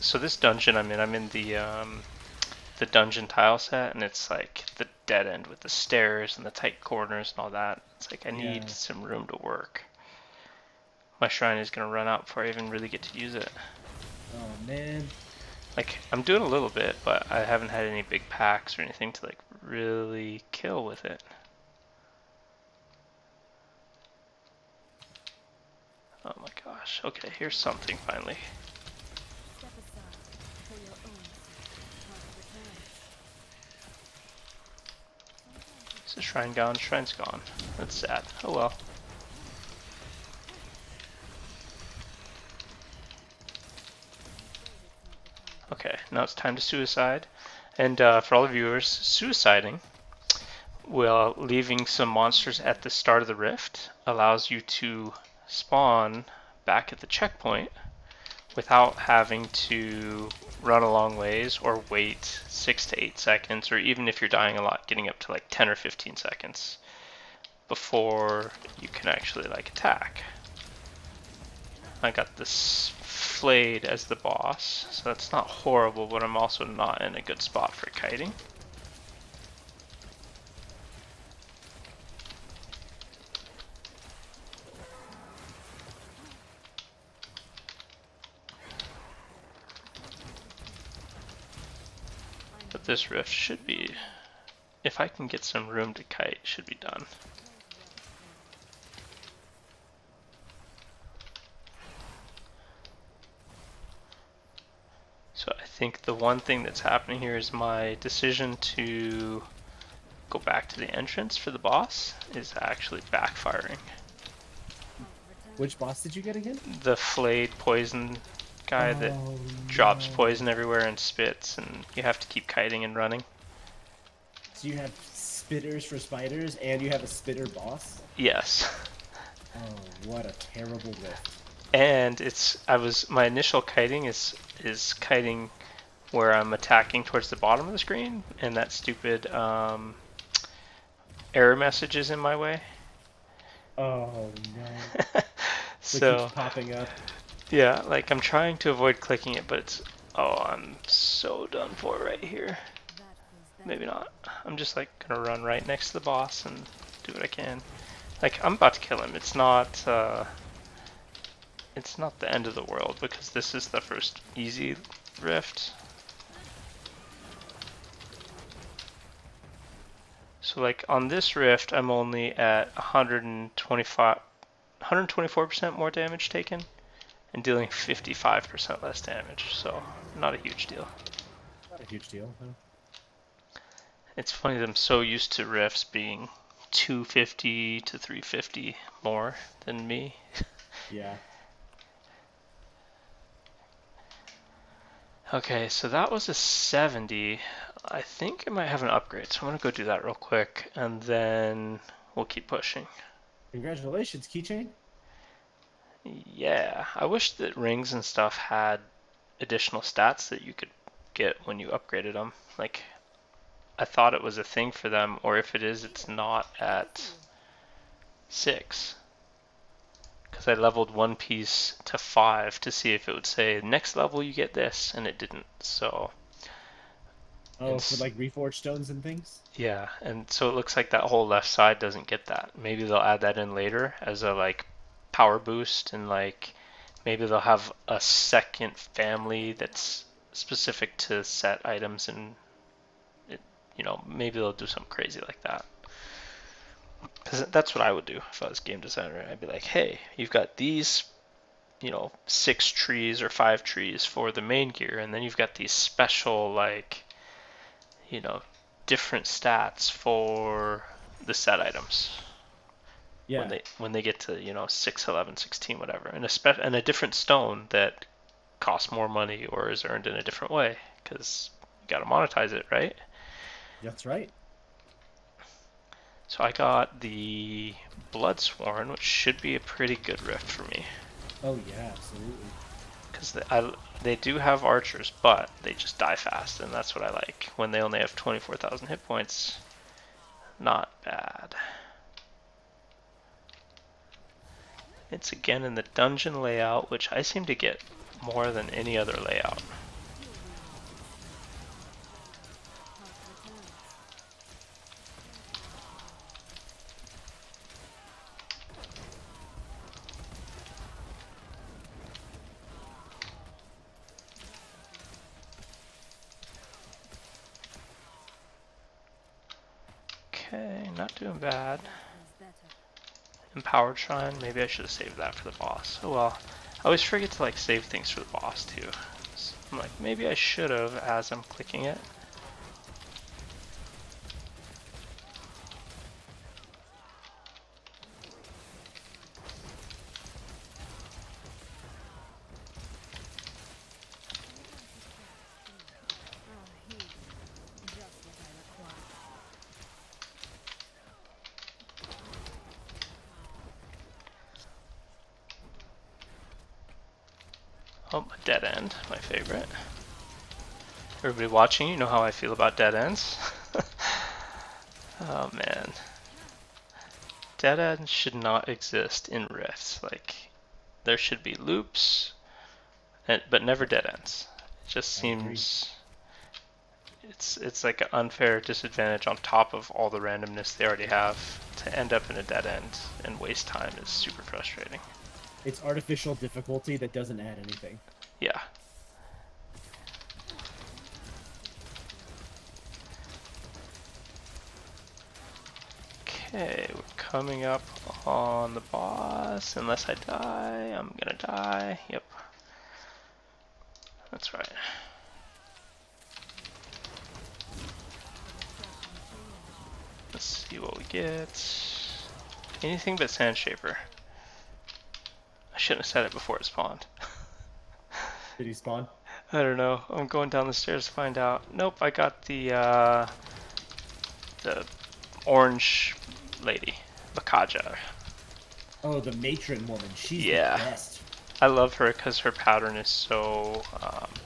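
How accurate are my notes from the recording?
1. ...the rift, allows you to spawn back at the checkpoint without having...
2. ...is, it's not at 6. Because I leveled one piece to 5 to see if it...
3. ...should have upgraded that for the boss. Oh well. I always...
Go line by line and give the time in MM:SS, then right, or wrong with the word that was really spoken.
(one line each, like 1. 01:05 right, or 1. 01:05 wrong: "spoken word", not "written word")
1. 00:53 right
2. 03:35 right
3. 05:24 wrong: "saved", not "upgraded".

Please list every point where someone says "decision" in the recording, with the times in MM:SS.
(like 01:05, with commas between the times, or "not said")
01:47.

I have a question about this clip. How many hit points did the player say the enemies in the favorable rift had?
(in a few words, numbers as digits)
24000.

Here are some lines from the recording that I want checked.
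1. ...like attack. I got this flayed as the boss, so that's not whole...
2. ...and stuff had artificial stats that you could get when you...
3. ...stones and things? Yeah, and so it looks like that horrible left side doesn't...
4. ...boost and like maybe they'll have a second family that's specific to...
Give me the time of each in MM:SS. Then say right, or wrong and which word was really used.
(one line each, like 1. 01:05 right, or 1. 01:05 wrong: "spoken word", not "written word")
1. 01:09 wrong: "horrible", not "whole"
2. 03:27 wrong: "additional", not "artificial"
3. 03:48 wrong: "whole", not "horrible"
4. 03:55 right.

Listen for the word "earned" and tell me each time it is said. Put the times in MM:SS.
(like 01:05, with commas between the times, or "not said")
04:29.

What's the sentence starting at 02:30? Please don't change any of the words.
Oh, I'm so done for right here.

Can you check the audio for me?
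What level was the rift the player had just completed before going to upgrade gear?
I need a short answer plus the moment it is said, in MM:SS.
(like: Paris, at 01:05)
70, at 03:16.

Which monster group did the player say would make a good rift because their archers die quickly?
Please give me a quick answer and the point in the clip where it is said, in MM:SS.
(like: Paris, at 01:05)
Bloodsworn, at 04:38.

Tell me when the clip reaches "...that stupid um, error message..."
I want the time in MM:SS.
02:18.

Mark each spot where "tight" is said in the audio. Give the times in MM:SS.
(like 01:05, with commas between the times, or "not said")
00:06.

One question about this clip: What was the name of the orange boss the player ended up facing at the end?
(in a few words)
Bakaja.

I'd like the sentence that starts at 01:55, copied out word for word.
Which boss did you get again?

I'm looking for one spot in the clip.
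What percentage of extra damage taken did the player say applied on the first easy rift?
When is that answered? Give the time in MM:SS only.
02:54.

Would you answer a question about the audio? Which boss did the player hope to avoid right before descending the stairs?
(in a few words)
Sand Shaper.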